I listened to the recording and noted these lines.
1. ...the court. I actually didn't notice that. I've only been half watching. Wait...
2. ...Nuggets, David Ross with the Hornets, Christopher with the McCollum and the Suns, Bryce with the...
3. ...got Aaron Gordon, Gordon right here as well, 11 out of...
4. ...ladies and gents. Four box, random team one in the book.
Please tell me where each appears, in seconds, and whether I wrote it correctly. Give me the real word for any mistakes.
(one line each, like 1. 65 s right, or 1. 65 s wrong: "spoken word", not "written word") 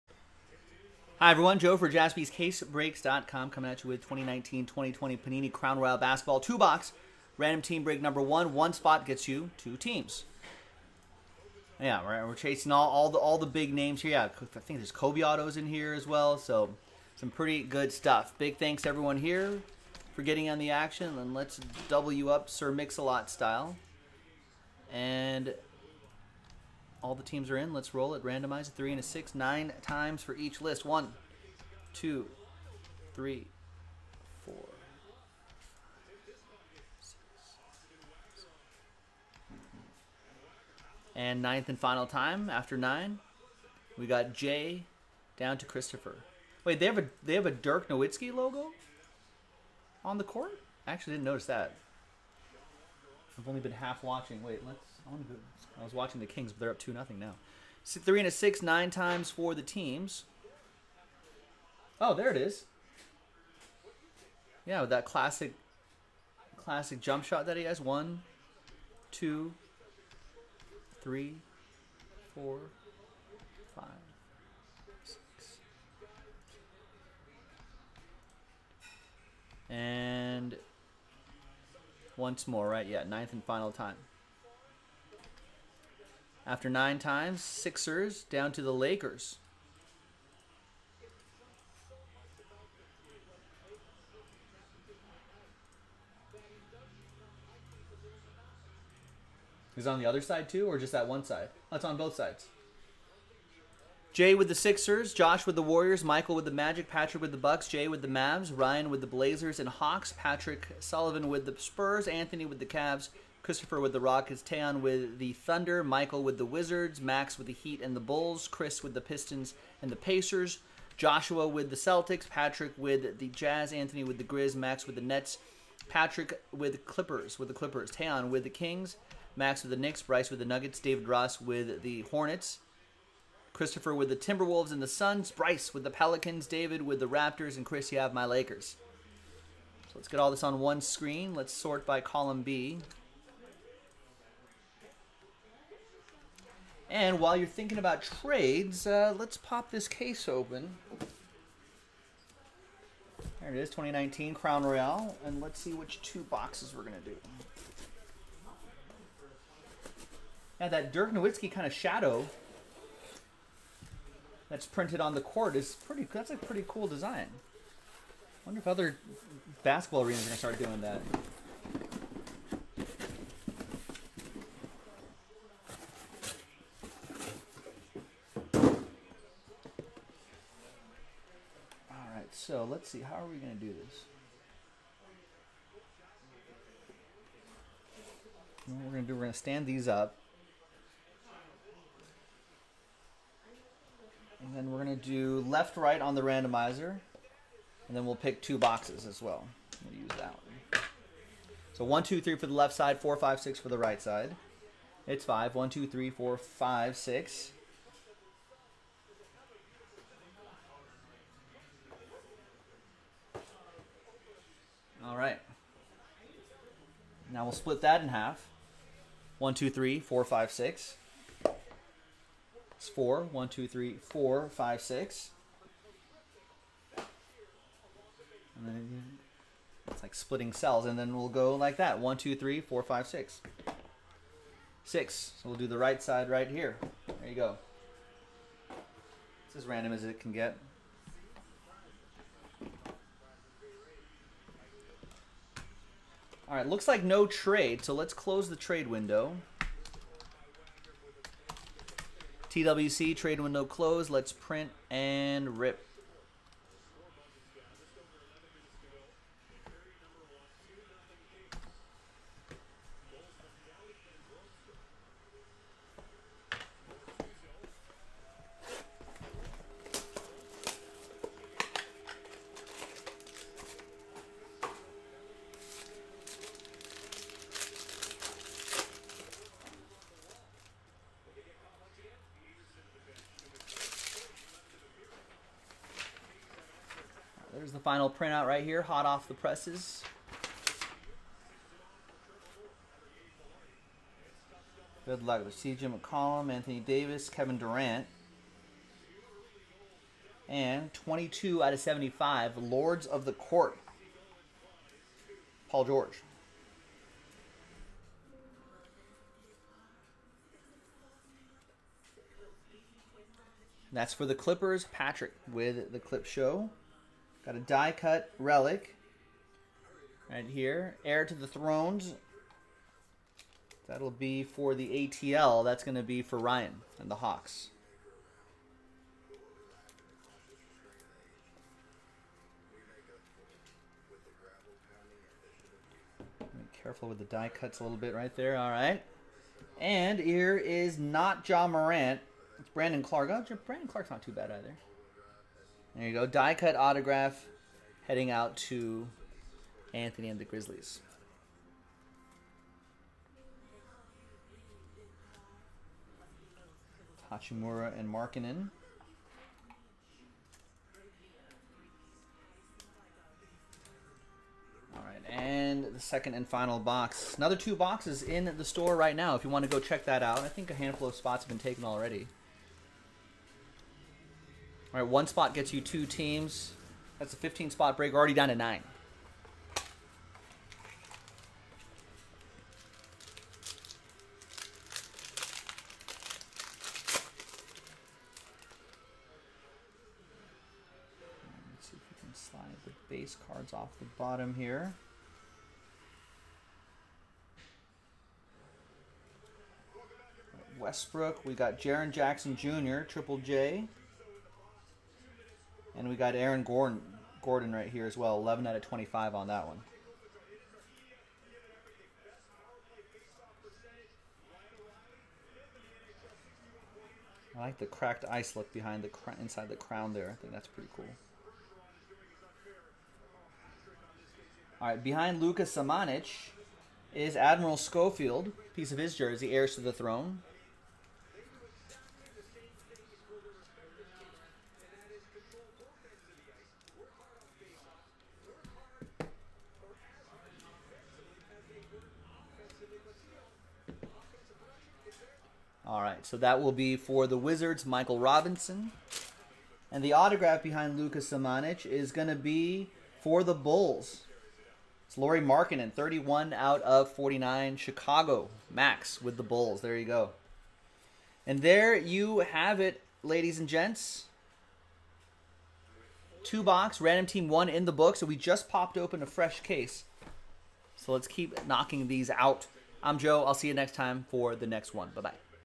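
1. 50 s right
2. 130 s wrong: "Timberwolves", not "McCollum"
3. 406 s right
4. 463 s wrong: "Two", not "Four".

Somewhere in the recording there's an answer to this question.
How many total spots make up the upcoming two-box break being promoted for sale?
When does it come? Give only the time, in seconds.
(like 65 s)
377 s.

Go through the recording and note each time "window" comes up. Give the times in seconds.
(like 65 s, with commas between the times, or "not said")
248 s, 253 s.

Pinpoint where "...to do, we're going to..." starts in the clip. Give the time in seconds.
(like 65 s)
189 s.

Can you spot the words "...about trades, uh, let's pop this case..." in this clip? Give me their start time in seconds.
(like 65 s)
147 s.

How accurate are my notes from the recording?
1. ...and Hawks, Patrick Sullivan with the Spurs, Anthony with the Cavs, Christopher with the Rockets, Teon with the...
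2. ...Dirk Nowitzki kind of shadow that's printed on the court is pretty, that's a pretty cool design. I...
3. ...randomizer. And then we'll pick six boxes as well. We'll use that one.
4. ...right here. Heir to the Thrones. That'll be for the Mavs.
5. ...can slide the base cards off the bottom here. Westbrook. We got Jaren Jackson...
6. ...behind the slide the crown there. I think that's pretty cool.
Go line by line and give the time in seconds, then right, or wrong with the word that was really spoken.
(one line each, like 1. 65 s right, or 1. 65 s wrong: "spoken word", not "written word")
1. 109 s right
2. 160 s right
3. 196 s wrong: "two", not "six"
4. 320 s wrong: "ATL", not "Mavs"
5. 392 s right
6. 418 s wrong: "inside", not "slide".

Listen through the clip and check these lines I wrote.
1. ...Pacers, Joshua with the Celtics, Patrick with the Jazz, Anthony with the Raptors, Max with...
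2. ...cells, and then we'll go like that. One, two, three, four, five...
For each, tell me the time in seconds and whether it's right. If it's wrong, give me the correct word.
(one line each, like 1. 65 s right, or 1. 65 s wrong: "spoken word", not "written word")
1. 119 s wrong: "Grizz", not "Raptors"
2. 230 s right.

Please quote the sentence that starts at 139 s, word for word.
So let's get all this on one screen.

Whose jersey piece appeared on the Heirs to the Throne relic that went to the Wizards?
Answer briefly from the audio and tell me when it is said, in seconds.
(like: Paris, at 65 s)
Admiral Schofield, at 427 s.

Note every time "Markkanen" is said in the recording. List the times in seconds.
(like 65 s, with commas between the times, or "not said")
358 s, 455 s.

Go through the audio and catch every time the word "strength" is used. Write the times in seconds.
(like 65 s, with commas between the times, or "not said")
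not said.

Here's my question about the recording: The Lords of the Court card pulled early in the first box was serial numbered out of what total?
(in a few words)
75.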